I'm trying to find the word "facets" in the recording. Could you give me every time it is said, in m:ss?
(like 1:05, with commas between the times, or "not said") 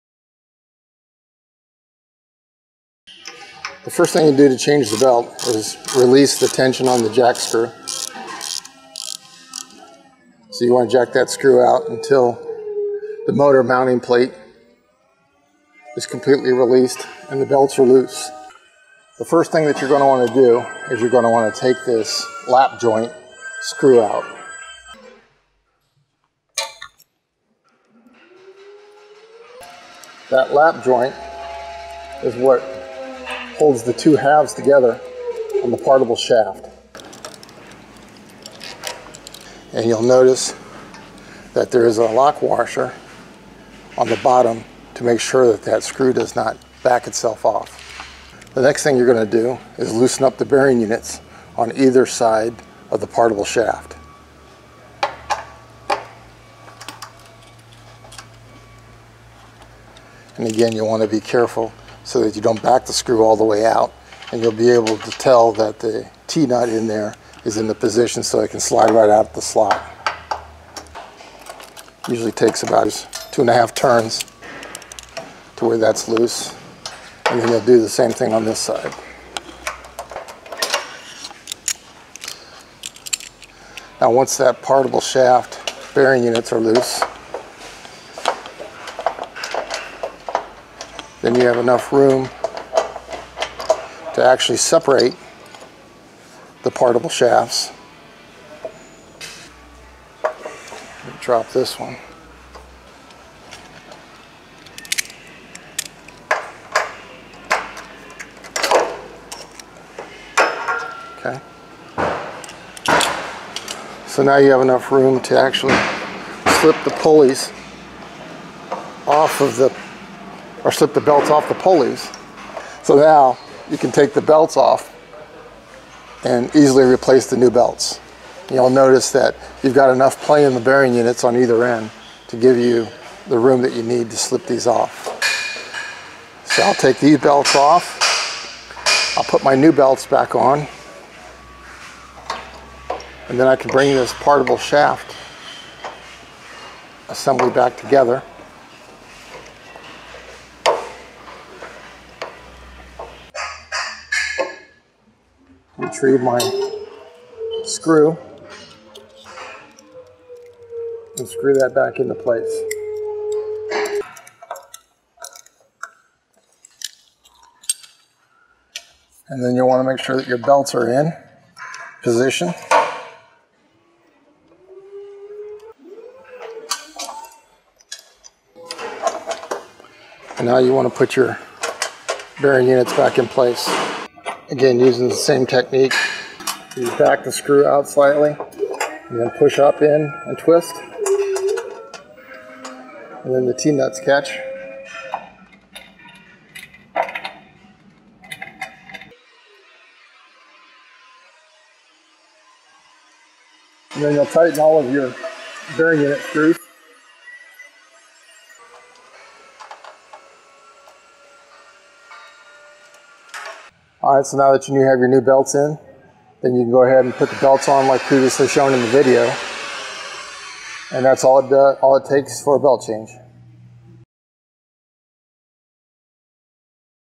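not said.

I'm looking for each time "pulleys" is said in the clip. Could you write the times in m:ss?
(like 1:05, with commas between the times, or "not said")
1:56, 2:01.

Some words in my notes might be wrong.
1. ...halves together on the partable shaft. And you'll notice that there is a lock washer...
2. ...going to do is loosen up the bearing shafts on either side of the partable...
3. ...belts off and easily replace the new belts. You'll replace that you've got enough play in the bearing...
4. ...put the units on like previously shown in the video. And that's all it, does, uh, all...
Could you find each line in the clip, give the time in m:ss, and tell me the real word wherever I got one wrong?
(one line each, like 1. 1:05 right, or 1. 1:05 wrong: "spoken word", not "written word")
1. 0:34 right
2. 0:49 wrong: "units", not "shafts"
3. 2:04 wrong: "notice", not "replace"
4. 3:37 wrong: "belts", not "units".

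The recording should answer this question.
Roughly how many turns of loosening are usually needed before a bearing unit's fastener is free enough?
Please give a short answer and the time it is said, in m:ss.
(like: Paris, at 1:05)
2.5 turns, at 1:13.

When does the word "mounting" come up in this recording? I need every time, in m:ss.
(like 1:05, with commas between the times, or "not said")
0:13.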